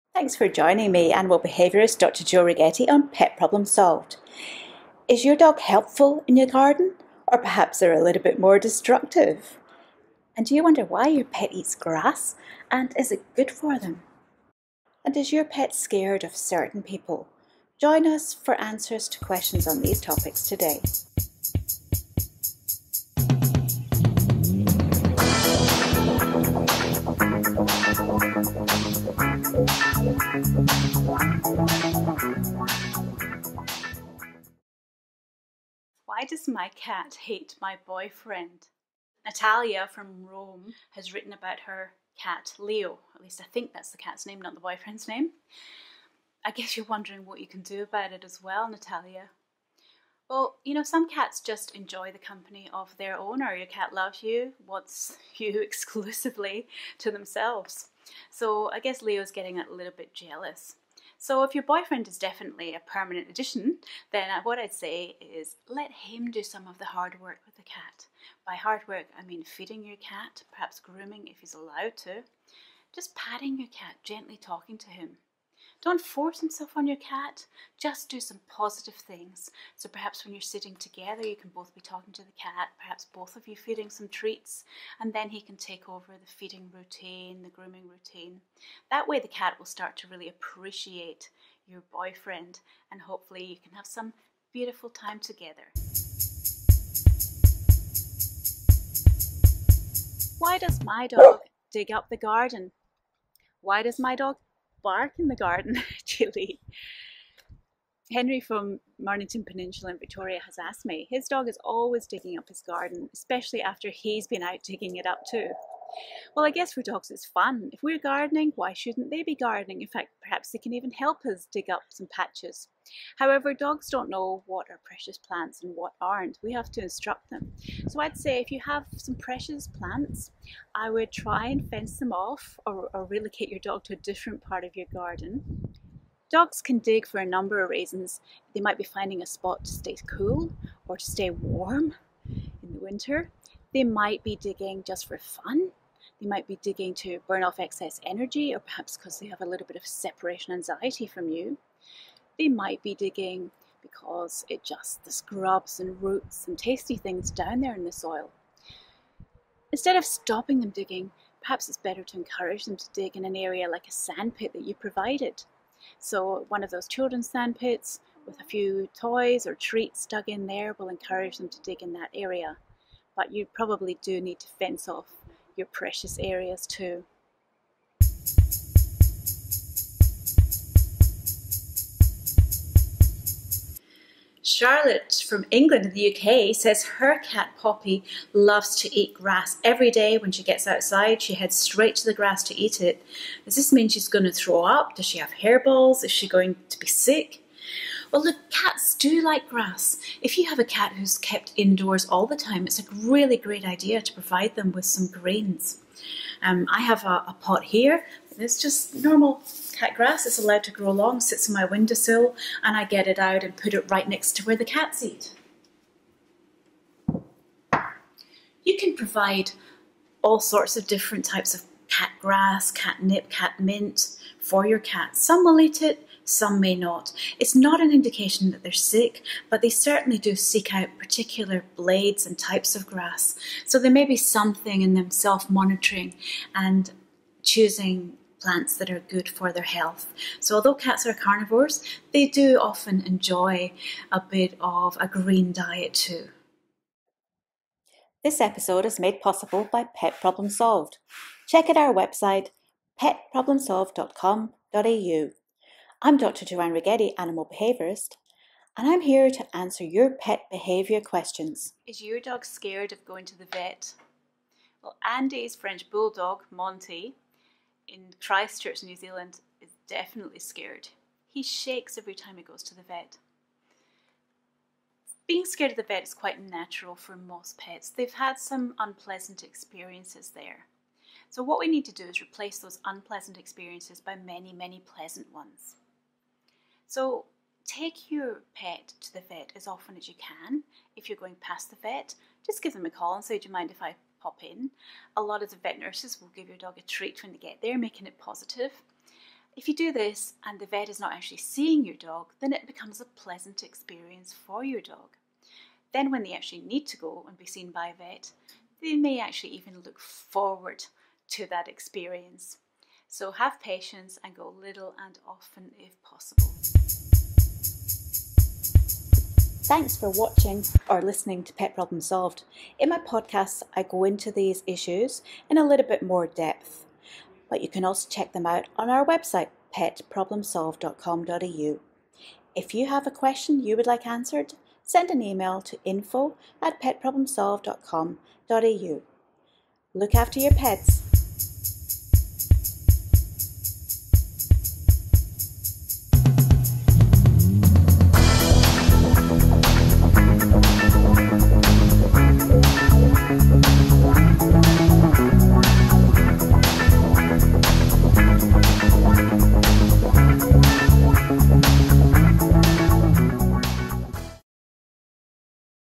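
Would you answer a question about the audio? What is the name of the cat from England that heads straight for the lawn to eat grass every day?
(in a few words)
Poppy.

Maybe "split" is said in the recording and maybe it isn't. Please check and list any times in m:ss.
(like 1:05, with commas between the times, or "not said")
not said.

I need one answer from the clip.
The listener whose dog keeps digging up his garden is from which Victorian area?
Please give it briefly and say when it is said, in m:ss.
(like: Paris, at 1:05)
Mornington Peninsula, at 1:48.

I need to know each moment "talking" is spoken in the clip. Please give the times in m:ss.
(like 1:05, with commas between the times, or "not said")
1:14, 1:21.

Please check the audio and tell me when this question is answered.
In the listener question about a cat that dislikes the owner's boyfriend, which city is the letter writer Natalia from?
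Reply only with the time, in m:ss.
0:40.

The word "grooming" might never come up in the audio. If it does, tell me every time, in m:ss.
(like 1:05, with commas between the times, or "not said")
1:10, 1:27.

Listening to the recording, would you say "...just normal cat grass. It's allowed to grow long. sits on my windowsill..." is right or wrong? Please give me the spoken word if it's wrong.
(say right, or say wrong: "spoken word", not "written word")
right.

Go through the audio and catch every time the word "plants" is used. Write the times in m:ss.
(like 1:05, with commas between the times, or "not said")
2:05, 2:09, 3:58.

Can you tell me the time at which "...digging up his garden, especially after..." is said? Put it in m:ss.
1:52.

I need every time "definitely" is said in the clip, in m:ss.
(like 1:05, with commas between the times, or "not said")
1:02, 4:29.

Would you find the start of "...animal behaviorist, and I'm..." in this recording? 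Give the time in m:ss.
4:17.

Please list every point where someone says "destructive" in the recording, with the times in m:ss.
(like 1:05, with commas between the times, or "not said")
0:08.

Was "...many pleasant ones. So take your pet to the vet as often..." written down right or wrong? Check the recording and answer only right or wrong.
right.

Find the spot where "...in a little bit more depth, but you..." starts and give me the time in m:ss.
5:25.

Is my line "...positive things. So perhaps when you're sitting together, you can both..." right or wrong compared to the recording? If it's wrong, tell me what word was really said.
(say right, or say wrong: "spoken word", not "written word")
right.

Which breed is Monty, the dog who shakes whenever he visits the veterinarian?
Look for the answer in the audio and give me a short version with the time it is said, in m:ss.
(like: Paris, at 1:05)
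French bulldog, at 4:25.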